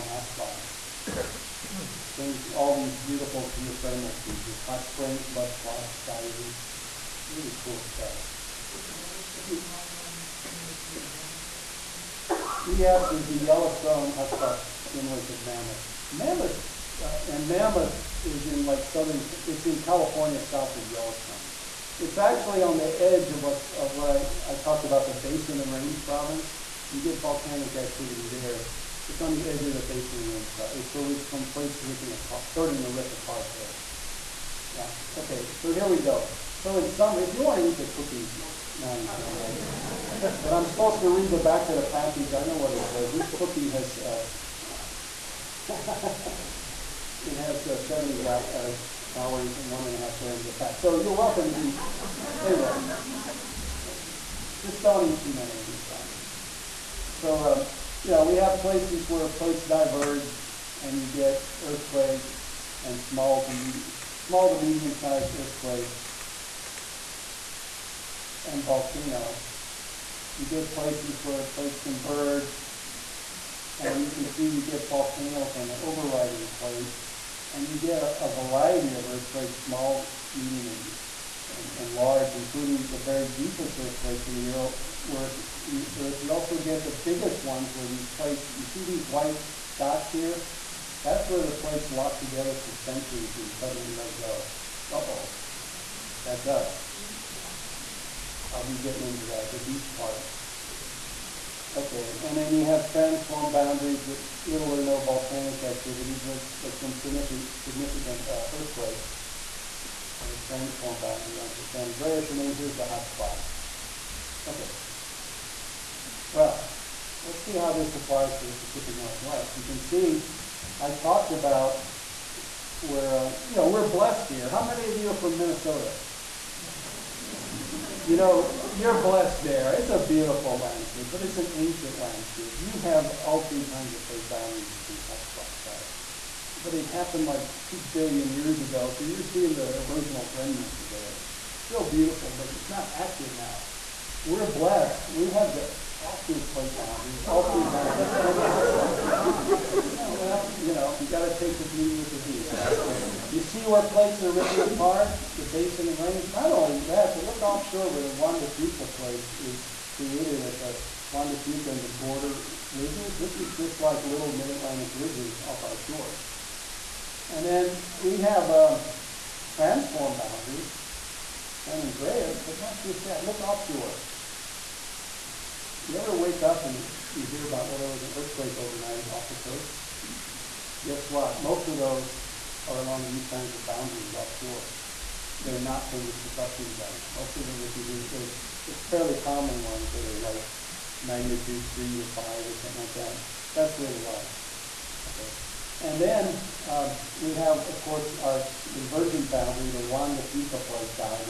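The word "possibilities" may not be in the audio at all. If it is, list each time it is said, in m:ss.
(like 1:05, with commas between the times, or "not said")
not said.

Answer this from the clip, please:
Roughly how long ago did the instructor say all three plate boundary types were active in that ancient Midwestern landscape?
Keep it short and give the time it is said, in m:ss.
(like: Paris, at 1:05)
2 billion years ago, at 2:17.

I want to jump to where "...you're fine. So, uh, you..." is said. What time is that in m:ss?
0:55.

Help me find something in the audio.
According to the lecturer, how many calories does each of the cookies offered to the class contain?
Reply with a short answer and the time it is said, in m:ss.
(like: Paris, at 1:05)
70, at 0:47.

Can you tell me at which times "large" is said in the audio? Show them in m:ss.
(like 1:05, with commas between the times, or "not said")
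1:21.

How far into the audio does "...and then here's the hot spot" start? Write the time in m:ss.
1:52.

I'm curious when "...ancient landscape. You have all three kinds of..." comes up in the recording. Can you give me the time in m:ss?
2:11.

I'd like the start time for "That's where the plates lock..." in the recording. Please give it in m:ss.
1:31.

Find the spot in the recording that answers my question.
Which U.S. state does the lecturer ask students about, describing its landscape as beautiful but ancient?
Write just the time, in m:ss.
2:05.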